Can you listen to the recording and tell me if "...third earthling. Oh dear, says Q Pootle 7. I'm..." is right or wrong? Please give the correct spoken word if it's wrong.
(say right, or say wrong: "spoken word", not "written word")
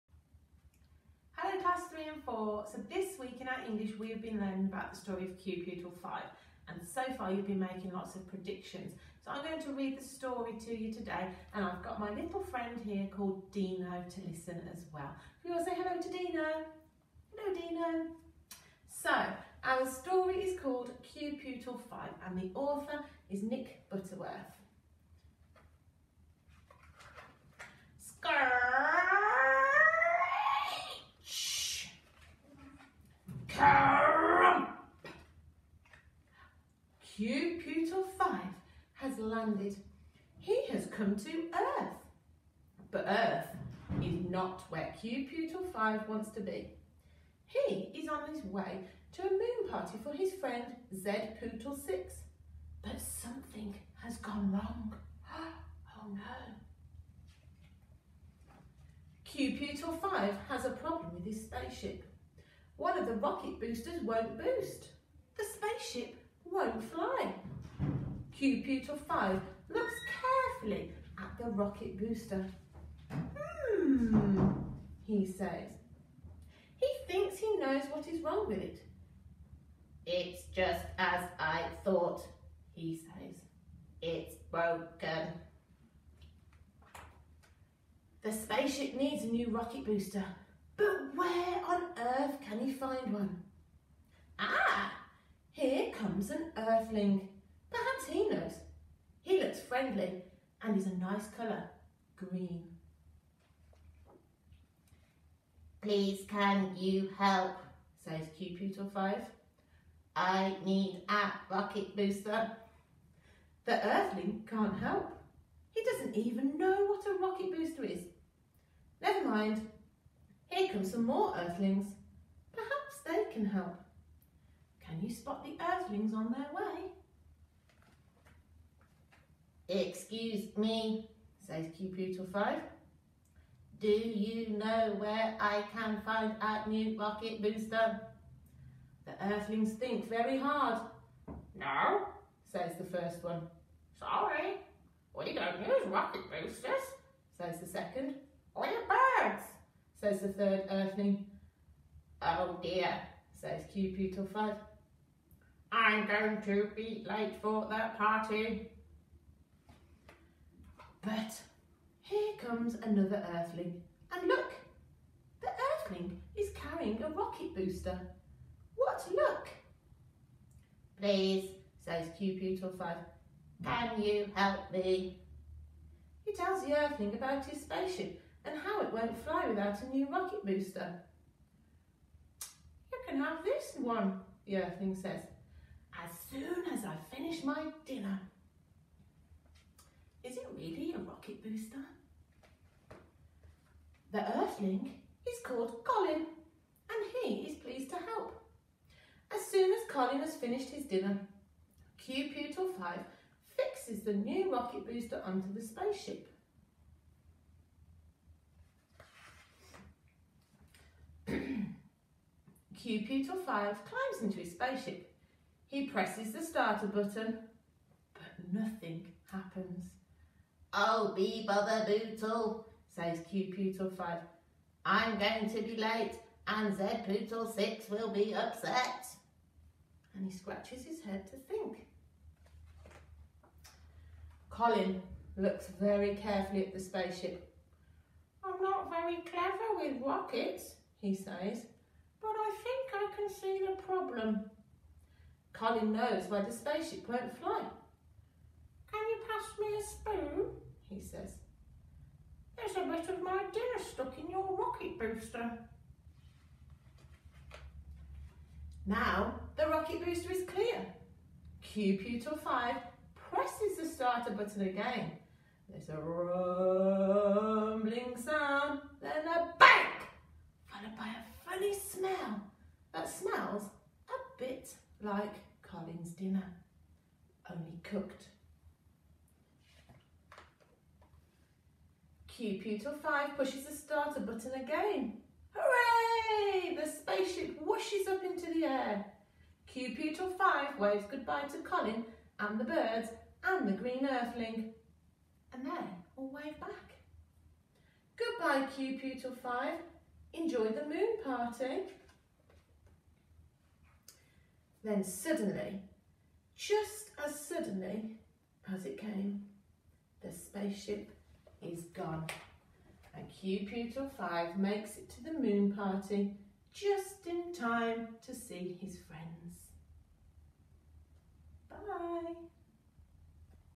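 wrong: "5", not "7".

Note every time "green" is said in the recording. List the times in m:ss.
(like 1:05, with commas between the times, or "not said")
1:42, 4:53.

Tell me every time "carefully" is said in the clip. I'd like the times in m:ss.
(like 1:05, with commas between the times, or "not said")
1:10, 3:56.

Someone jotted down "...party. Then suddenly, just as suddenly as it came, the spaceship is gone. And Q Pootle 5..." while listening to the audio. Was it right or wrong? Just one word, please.
right.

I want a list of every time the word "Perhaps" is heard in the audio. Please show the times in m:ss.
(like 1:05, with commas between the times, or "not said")
2:02.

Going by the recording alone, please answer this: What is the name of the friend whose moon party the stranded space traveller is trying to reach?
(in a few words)
Zed Pootle 6.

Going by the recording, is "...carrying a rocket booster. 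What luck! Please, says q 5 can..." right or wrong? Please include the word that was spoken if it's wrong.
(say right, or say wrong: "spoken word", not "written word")
right.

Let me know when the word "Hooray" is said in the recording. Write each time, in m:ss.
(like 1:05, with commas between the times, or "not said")
4:45.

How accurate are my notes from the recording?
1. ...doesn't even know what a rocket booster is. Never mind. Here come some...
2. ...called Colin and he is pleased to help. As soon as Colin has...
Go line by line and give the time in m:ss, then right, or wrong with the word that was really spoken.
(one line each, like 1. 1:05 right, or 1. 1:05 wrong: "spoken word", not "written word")
1. 1:55 right
2. 3:15 right.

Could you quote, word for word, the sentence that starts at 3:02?
You can have this one, the Earthling says, as soon as I finish my dinner.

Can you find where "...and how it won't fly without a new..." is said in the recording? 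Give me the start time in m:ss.
2:58.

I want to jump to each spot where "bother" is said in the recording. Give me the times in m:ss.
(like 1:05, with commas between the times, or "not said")
3:41.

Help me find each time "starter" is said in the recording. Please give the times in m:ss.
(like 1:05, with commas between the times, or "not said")
3:36, 4:23, 4:43.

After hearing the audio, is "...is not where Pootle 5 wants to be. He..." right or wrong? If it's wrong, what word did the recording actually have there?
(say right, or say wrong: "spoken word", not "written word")
right.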